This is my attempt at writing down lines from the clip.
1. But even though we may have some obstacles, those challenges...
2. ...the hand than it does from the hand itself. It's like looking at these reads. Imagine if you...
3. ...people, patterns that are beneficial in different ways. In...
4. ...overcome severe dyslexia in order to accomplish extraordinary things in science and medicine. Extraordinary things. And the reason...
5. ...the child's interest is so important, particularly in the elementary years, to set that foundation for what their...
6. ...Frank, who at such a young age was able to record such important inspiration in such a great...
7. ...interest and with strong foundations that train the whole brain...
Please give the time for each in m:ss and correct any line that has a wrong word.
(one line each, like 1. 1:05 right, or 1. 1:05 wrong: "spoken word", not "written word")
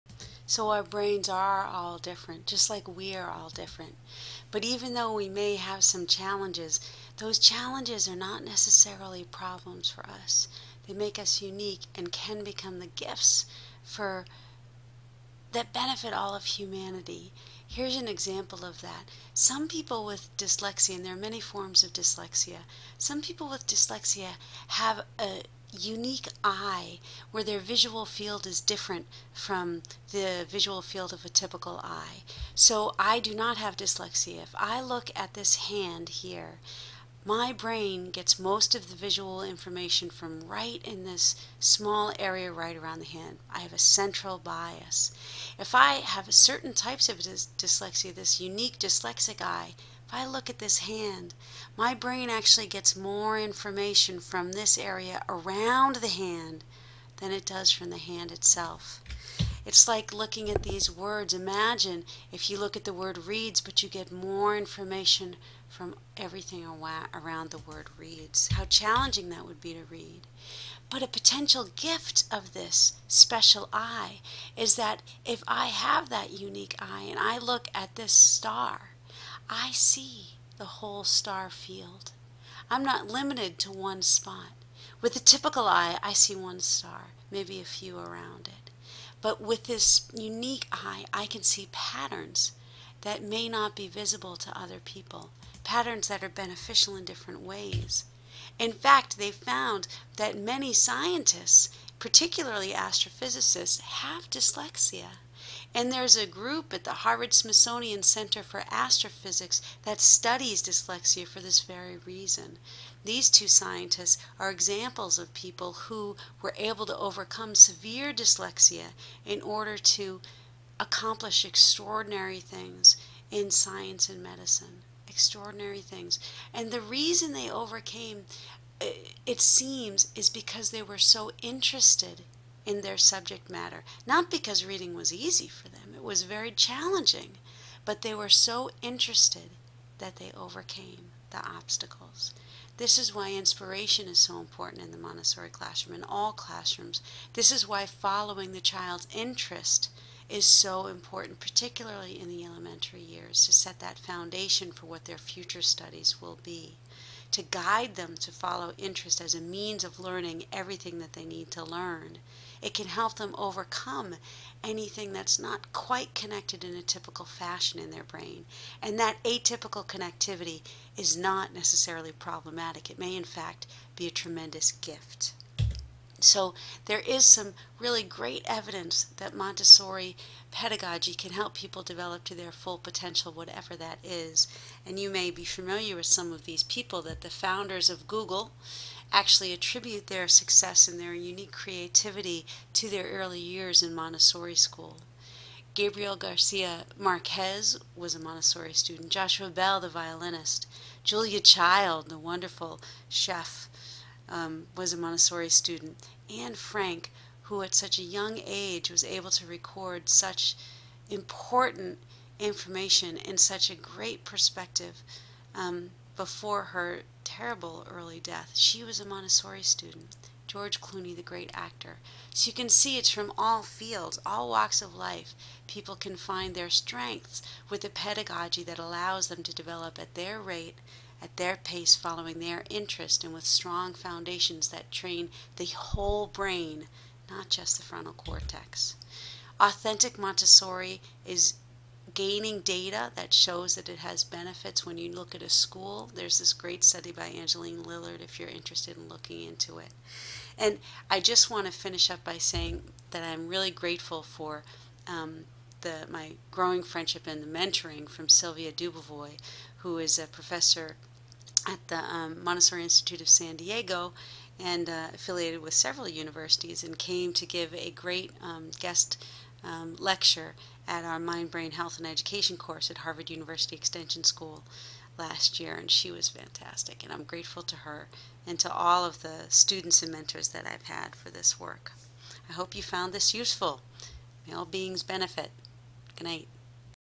1. 0:04 wrong: "challenges", not "obstacles"
2. 0:55 wrong: "words", not "reads"
3. 1:34 right
4. 1:56 right
5. 2:28 right
6. 3:26 wrong: "information", not "inspiration"
7. 3:52 right.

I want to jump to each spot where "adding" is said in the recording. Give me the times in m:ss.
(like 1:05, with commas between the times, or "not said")
not said.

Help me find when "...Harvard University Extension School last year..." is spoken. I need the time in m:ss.
4:32.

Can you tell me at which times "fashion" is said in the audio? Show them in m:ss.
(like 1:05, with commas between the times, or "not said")
2:47.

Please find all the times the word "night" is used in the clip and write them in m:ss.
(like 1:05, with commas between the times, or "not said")
4:46.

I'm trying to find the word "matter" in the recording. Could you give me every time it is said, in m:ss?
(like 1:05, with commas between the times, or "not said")
2:13.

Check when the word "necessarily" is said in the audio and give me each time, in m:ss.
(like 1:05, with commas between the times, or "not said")
0:08, 2:51.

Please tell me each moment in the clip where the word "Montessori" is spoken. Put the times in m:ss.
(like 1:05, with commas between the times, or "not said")
2:24, 2:59, 3:13, 3:18, 3:24, 3:39, 4:00, 4:22.